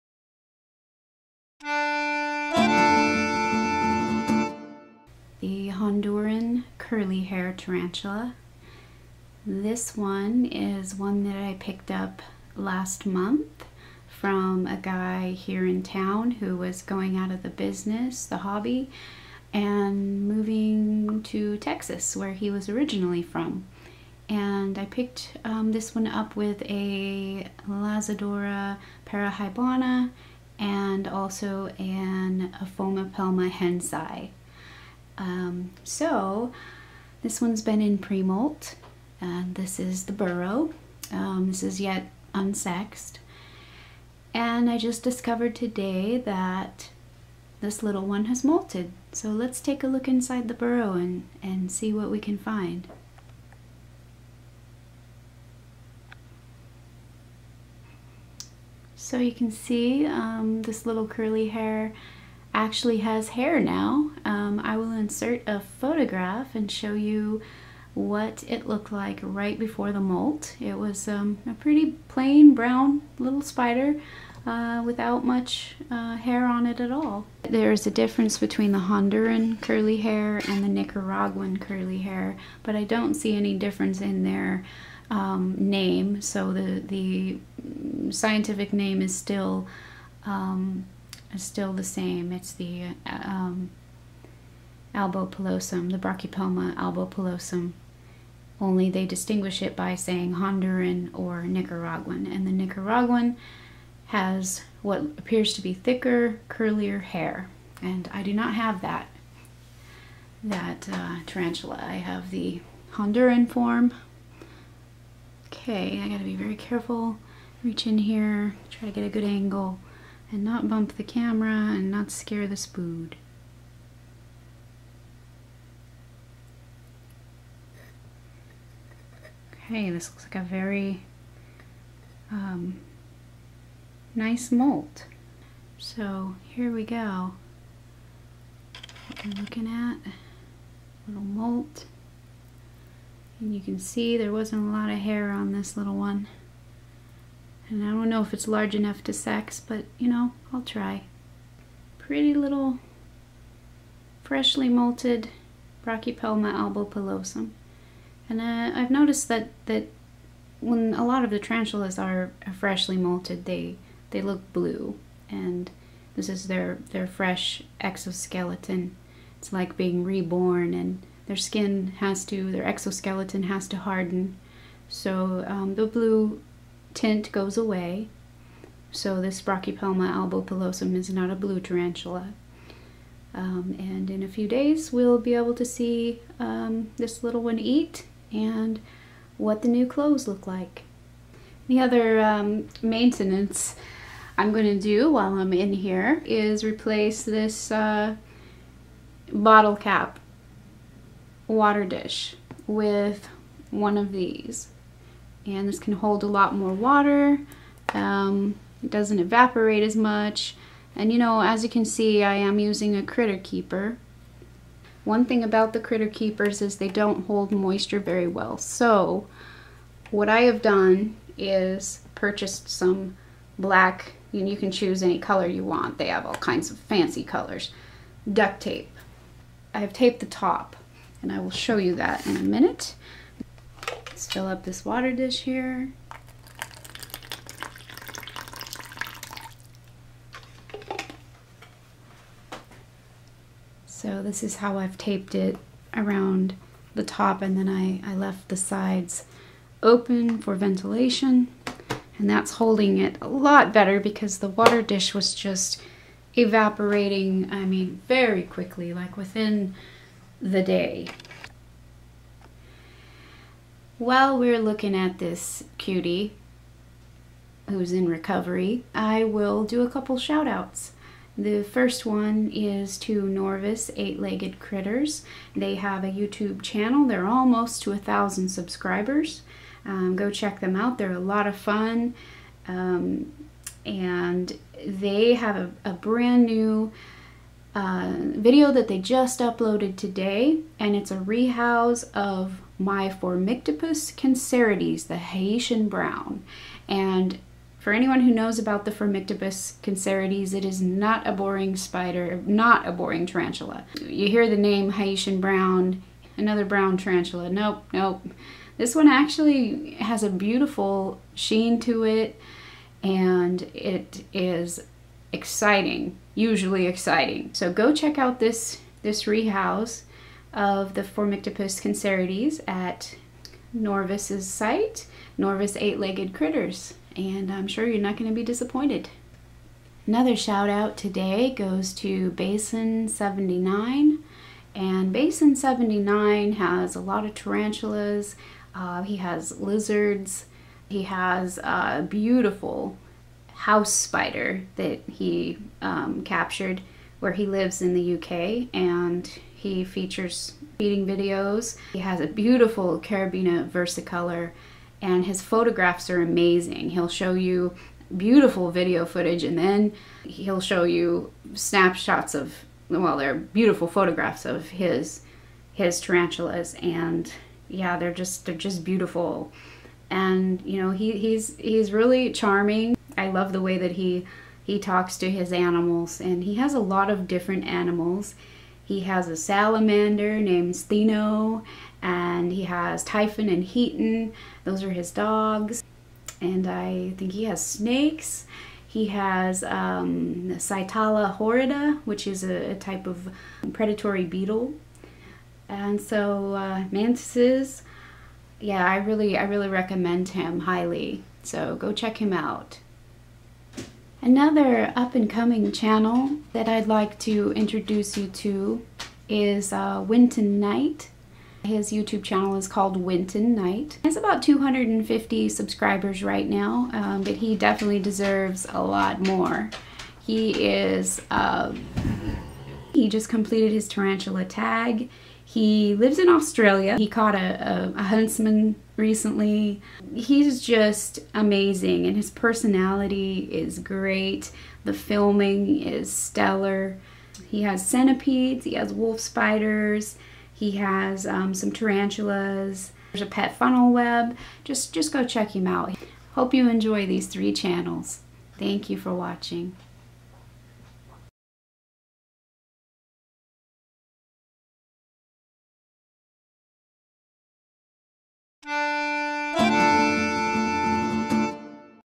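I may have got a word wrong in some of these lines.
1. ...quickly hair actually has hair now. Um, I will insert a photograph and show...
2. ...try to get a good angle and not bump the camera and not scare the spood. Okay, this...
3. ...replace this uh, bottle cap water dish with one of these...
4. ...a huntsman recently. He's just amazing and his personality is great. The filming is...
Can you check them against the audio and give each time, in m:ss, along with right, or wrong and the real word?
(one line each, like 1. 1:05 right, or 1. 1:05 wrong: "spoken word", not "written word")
1. 1:01 wrong: "curly", not "quickly"
2. 1:58 right
3. 3:16 right
4. 7:07 right.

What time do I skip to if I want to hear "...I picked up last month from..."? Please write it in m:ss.
0:11.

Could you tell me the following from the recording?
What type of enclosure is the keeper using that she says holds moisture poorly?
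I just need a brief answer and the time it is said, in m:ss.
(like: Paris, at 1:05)
Critter keeper, at 3:33.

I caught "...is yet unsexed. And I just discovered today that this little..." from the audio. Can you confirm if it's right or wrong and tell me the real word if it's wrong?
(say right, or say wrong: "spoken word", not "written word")
right.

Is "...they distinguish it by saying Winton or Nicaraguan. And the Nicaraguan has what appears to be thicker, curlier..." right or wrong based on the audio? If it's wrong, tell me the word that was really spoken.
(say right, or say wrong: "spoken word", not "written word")
wrong: "Honduran", not "Winton".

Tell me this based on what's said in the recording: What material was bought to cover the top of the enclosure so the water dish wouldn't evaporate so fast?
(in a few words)
Duct tape.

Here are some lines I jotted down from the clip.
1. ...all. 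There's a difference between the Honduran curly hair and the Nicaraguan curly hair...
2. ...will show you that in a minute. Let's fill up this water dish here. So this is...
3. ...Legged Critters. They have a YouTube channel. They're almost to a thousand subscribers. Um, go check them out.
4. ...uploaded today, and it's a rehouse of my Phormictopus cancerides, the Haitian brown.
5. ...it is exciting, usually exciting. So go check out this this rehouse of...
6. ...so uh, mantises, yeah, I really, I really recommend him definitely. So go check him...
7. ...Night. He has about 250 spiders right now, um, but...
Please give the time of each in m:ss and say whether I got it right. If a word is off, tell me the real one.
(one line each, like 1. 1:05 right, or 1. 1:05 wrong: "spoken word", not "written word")
1. 1:16 right
2. 3:51 right
3. 4:34 right
4. 4:49 right
5. 5:13 right
6. 6:36 wrong: "highly", not "definitely"
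7. 6:53 wrong: "subscribers", not "spiders".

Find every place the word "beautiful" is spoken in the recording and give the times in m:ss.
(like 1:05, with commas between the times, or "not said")
5:10, 5:42, 5:52, 5:58, 6:03, 6:08.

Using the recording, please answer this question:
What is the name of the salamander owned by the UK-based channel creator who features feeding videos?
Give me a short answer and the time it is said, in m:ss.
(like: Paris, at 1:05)
Steno, at 6:20.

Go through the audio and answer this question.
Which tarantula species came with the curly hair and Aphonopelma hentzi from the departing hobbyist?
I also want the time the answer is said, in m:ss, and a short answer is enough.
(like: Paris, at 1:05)
Lasiodora parahybana, at 0:27.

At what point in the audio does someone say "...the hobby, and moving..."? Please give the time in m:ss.
0:18.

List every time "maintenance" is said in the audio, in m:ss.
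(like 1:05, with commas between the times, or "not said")
3:12.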